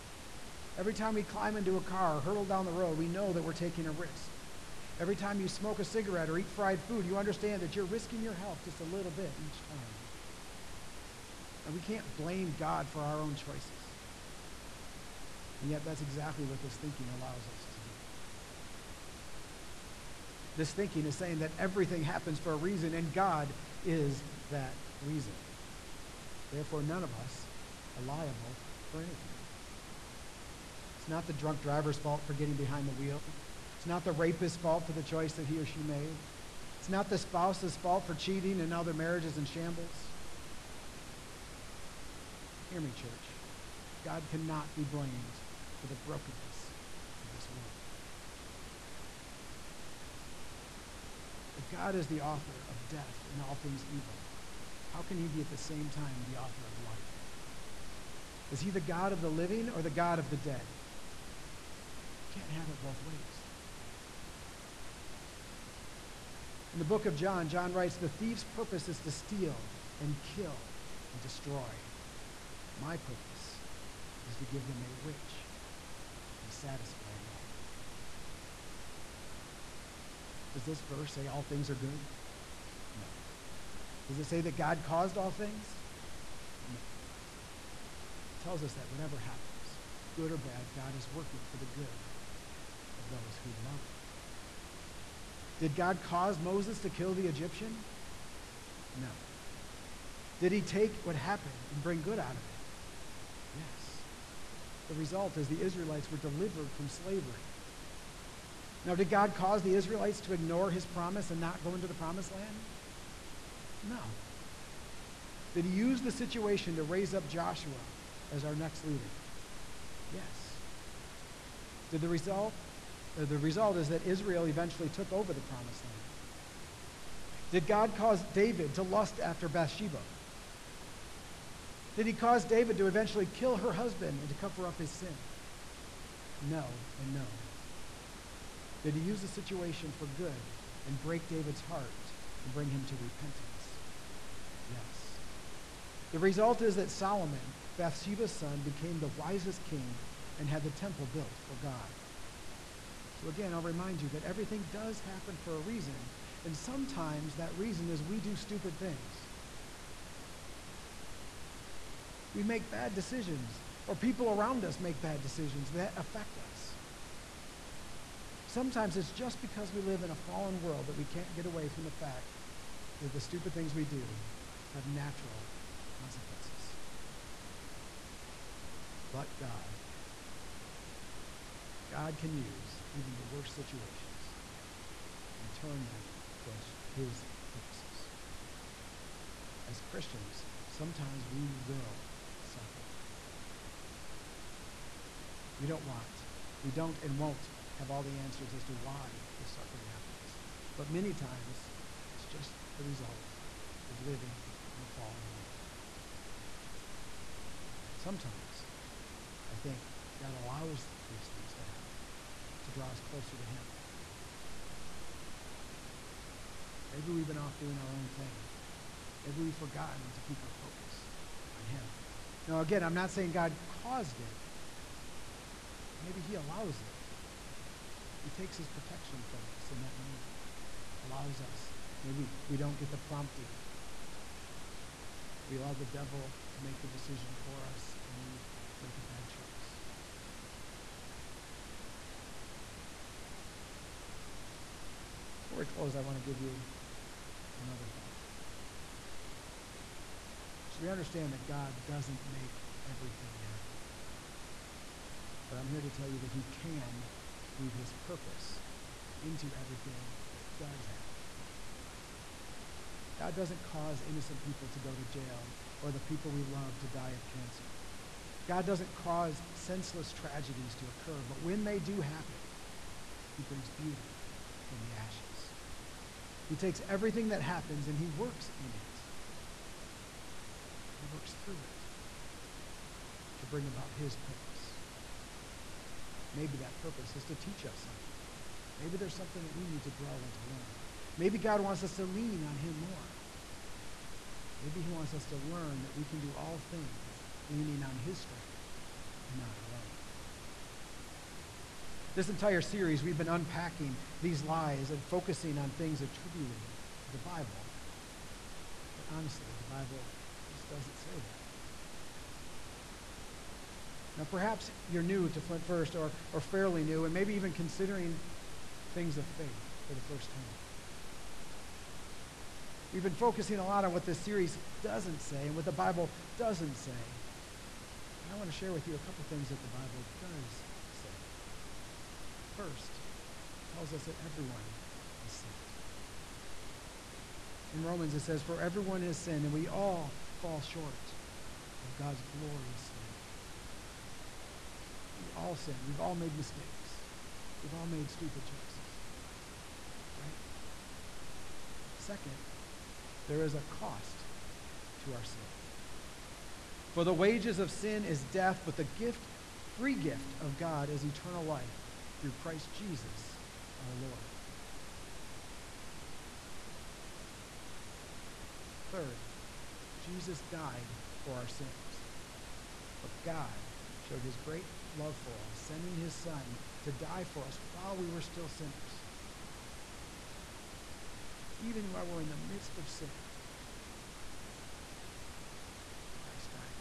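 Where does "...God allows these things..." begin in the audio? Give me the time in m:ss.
3:30.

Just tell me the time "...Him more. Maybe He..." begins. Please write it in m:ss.
4:52.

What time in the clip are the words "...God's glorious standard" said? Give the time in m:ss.
5:41.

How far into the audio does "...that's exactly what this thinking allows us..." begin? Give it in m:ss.
0:15.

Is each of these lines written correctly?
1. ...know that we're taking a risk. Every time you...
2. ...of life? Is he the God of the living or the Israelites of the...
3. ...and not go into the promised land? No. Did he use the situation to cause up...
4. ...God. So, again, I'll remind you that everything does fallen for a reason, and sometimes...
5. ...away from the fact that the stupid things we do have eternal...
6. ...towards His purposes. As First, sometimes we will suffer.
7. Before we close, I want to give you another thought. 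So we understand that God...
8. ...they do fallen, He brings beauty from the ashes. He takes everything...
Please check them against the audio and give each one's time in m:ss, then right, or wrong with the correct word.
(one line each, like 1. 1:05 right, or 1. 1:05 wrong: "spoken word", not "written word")
1. 0:03 right
2. 0:56 wrong: "God", not "Israelites"
3. 1:51 wrong: "raise", not "cause"
4. 2:31 wrong: "happen", not "fallen"
5. 2:51 wrong: "natural", not "eternal"
6. 3:06 wrong: "Christians", not "First"
7. 4:05 right
8. 4:31 wrong: "happen", not "fallen".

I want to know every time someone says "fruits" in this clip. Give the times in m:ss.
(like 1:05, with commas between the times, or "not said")
not said.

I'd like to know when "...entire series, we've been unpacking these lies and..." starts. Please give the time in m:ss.
5:02.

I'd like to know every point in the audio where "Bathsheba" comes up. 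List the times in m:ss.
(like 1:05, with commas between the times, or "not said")
2:09, 2:27.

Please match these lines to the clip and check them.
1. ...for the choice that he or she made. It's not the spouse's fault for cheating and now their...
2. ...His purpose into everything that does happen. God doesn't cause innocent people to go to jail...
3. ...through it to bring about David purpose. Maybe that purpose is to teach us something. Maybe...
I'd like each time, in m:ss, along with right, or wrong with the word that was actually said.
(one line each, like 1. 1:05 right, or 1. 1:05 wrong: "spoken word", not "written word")
1. 0:34 right
2. 4:17 right
3. 4:41 wrong: "His", not "David".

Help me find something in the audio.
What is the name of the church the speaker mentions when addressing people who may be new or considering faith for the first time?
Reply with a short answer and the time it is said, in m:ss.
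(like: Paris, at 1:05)
Flint First, at 5:15.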